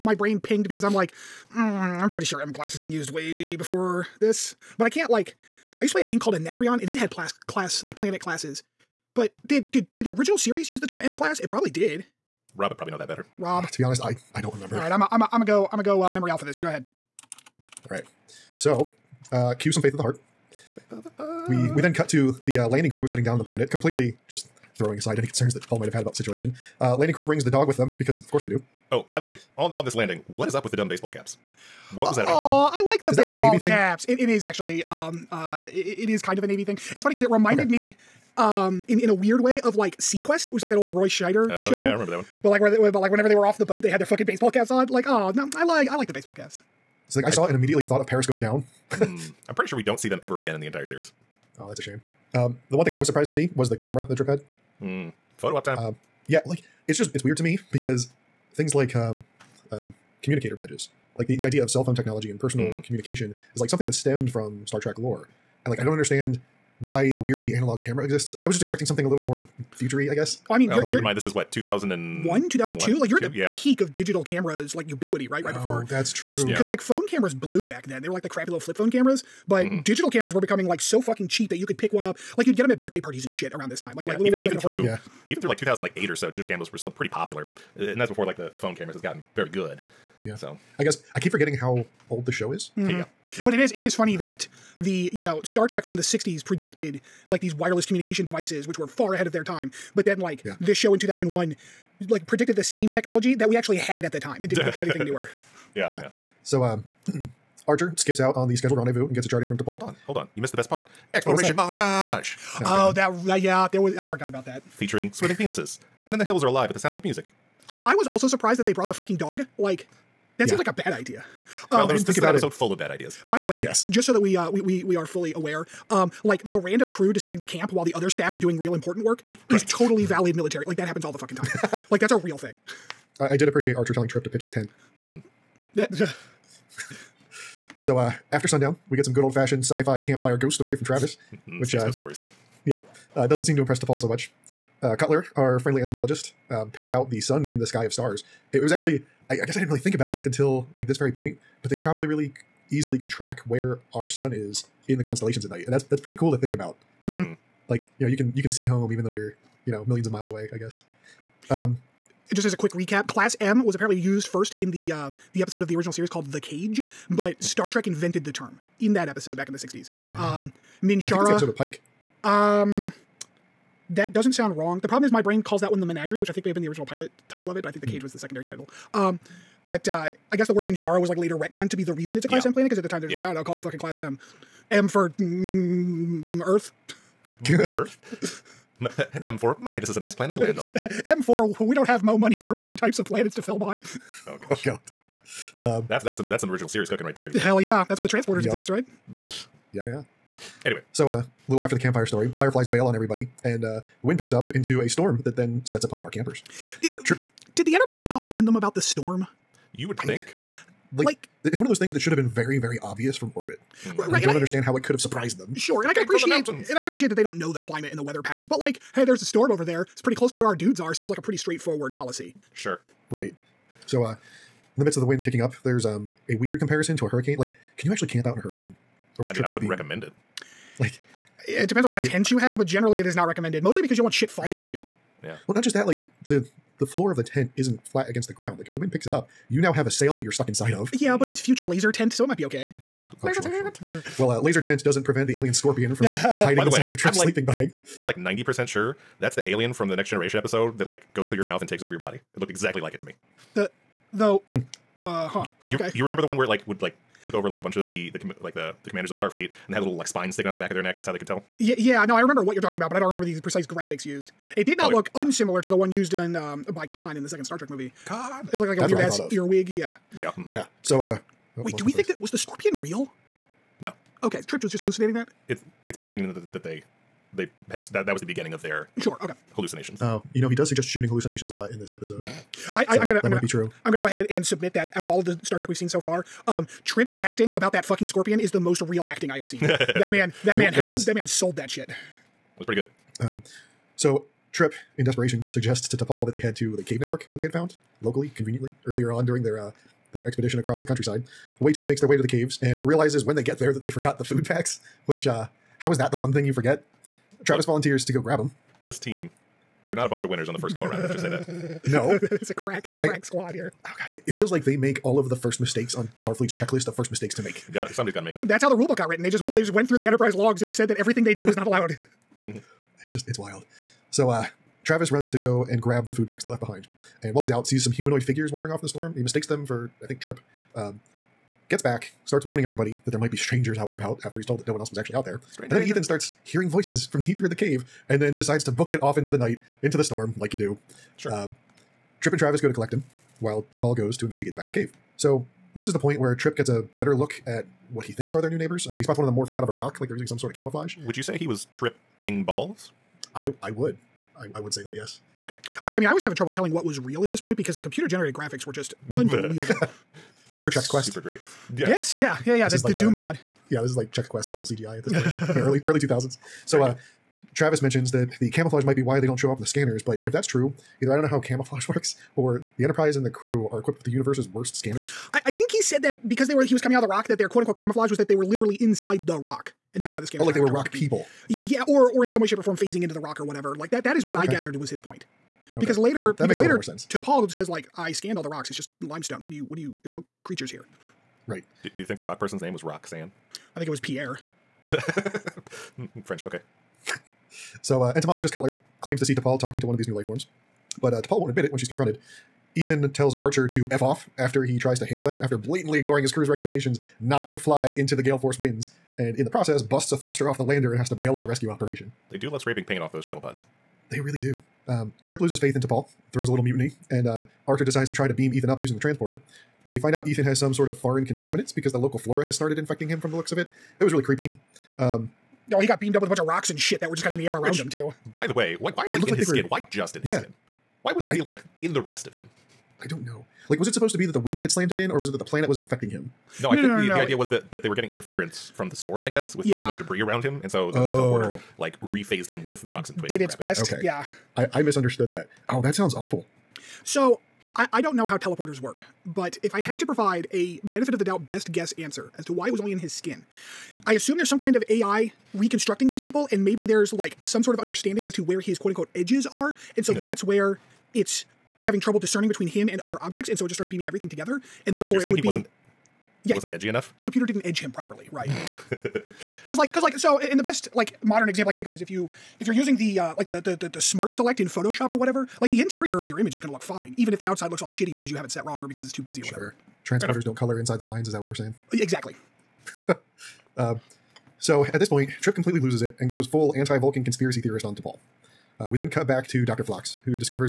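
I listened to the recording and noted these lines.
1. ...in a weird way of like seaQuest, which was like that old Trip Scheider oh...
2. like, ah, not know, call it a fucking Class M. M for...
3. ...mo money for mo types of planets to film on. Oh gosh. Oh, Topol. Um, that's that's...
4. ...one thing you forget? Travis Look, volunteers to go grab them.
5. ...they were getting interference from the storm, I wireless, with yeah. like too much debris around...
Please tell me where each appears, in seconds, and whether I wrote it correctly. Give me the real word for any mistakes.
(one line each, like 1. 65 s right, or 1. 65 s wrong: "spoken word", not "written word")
1. 38 s wrong: "Roy", not "Trip"
2. 183 s right
3. 192 s wrong: "God", not "Topol"
4. 306 s right
5. 437 s wrong: "guess", not "wireless".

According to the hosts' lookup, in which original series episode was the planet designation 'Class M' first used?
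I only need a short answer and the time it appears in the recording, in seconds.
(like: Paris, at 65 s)
The Cage, at 166 s.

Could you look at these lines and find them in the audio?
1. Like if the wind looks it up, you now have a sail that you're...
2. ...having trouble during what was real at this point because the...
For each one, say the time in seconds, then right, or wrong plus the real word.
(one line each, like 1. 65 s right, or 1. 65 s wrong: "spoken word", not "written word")
1. 238 s wrong: "picks", not "looks"
2. 356 s wrong: "telling", not "during".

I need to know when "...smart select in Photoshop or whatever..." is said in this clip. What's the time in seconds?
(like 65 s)
474 s.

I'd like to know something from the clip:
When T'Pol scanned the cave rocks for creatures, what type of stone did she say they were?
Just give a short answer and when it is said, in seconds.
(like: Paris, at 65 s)
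Limestone, at 389 s.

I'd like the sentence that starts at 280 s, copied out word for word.
Oh, you know, he does suggest shooting hallucinations a lot in this episode.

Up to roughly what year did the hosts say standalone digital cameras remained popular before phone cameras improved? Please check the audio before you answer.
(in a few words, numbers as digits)
2008.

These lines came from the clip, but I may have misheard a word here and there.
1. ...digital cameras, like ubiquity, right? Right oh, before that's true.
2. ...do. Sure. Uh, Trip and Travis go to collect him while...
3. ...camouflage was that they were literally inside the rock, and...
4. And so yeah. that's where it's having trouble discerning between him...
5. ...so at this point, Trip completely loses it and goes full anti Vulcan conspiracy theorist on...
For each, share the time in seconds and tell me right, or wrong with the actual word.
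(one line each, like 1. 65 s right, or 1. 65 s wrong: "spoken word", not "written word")
1. 73 s right
2. 340 s right
3. 377 s right
4. 459 s right
5. 484 s right.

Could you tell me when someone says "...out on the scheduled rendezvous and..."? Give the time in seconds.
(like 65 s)
108 s.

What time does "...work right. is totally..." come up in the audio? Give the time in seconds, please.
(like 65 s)
129 s.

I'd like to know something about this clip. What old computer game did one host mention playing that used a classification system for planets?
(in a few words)
Anacreon.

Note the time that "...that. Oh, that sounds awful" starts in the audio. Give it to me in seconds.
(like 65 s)
445 s.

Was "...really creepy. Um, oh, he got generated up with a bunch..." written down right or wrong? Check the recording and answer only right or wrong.
wrong.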